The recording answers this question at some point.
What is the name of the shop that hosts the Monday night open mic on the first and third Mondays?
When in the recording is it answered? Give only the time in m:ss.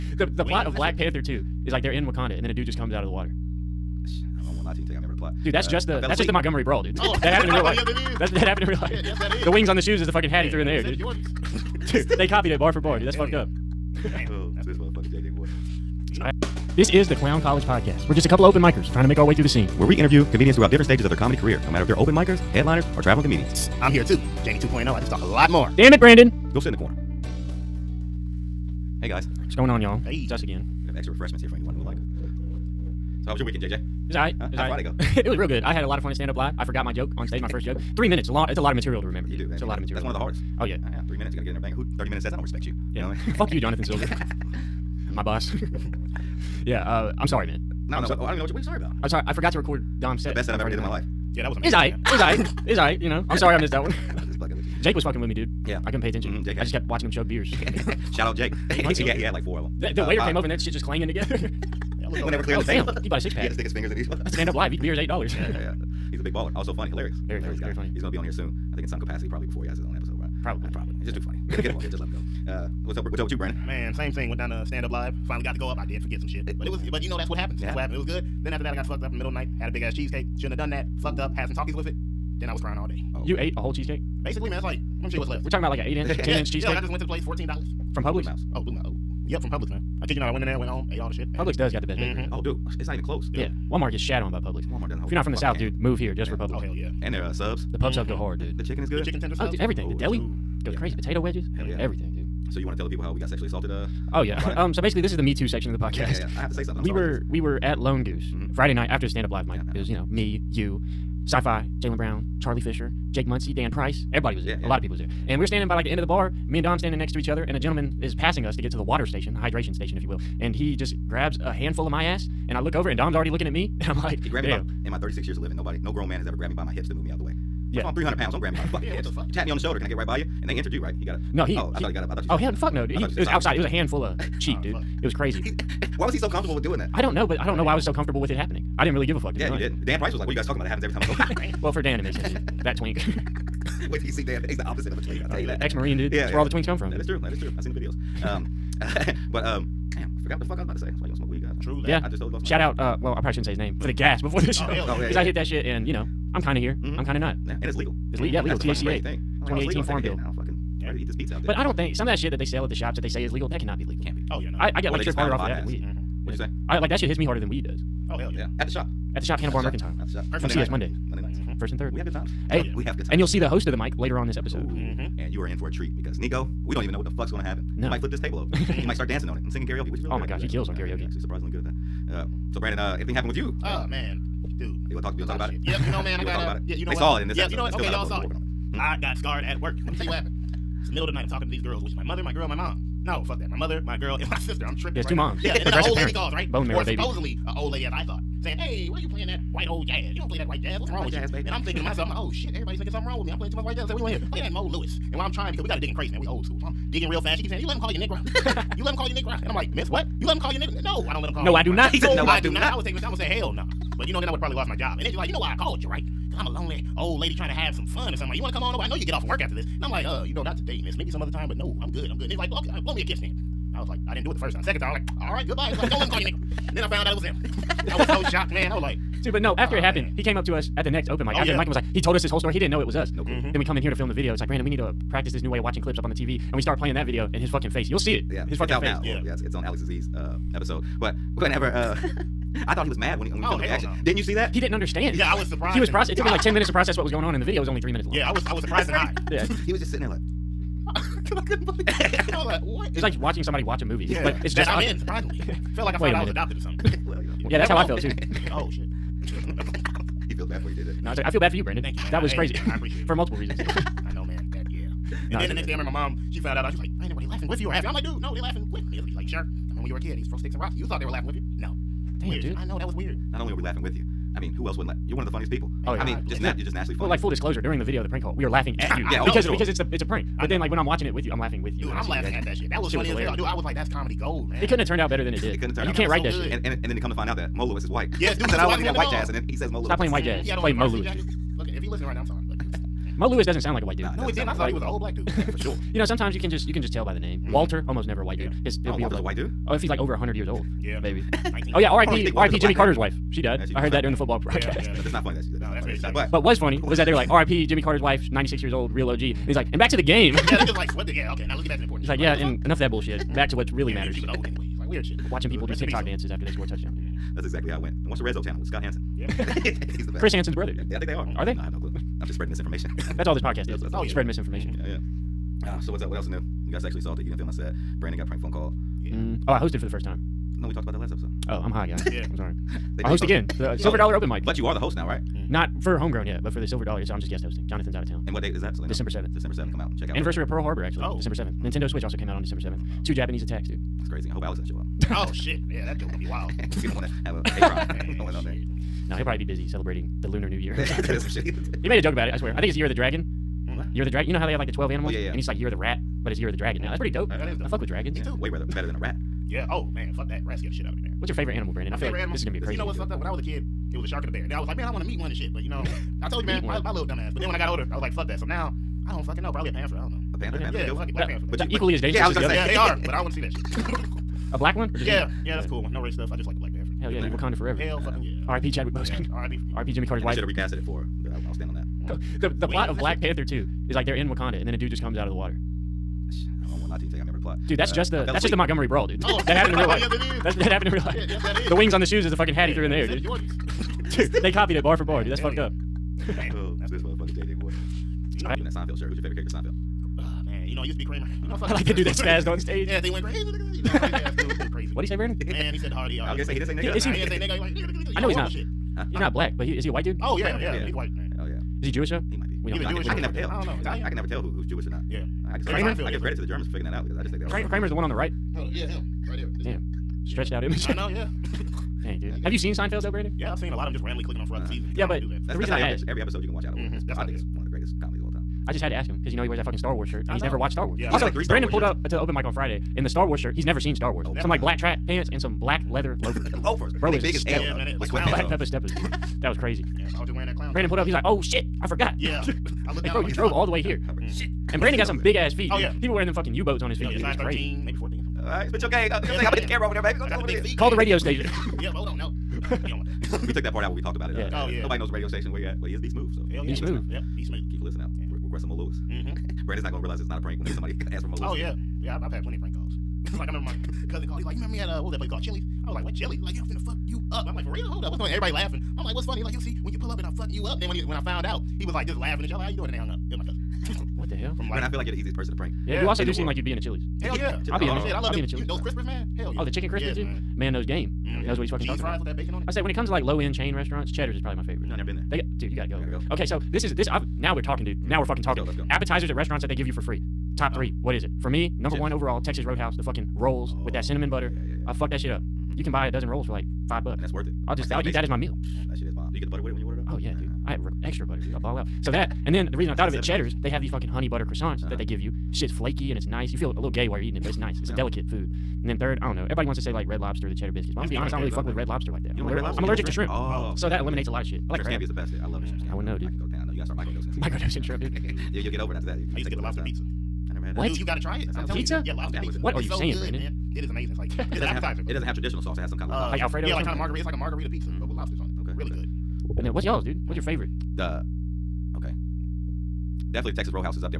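2:49.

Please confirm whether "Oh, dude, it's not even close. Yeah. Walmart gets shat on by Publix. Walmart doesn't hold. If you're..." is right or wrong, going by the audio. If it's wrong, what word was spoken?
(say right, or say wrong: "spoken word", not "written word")
right.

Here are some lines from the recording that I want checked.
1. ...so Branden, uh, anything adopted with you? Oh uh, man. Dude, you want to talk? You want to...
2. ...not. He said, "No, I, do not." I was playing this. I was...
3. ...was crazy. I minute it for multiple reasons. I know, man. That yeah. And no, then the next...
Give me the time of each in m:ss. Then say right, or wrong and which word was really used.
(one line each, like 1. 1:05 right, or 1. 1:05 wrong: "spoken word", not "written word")
1. 3:02 wrong: "happened", not "adopted"
2. 3:31 wrong: "taking", not "playing"
3. 4:22 wrong: "appreciate", not "minute".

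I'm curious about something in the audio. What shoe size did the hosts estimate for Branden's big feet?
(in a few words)
13.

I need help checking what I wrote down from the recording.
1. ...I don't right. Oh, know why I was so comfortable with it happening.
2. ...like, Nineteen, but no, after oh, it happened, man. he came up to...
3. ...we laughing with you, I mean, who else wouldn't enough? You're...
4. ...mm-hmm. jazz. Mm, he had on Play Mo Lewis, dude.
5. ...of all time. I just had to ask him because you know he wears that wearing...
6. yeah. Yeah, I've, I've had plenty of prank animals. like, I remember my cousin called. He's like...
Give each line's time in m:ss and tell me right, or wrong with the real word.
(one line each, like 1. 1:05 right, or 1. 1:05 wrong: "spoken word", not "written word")
1. 2:17 right
2. 3:48 wrong: "Dude", not "Nineteen"
3. 4:33 wrong: "laugh", not "enough"
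4. 4:50 right
5. 7:08 wrong: "fucking", not "wearing"
6. 7:41 wrong: "calls", not "animals".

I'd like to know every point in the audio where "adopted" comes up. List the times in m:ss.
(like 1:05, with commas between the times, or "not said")
4:16.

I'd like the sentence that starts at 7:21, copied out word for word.
He's like, "Oh shit." I forgot.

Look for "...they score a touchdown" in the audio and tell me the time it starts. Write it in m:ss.
5:16.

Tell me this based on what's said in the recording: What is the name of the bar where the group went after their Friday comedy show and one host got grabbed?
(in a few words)
Lone Goose.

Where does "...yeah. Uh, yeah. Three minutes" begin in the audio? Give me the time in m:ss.
0:40.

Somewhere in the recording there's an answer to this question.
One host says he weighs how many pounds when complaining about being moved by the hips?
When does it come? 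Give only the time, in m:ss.
2:07.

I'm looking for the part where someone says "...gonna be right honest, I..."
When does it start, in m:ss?
8:31.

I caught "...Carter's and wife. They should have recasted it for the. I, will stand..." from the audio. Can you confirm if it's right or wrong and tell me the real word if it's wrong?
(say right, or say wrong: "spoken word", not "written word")
right.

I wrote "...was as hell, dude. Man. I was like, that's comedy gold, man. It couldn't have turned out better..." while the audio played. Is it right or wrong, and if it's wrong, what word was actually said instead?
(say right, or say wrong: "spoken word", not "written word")
right.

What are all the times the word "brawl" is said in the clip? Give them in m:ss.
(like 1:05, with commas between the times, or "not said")
0:06, 6:28.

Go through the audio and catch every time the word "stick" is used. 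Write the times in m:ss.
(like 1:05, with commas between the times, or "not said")
1:03, 4:30.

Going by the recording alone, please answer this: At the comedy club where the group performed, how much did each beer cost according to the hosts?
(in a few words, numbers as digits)
$8.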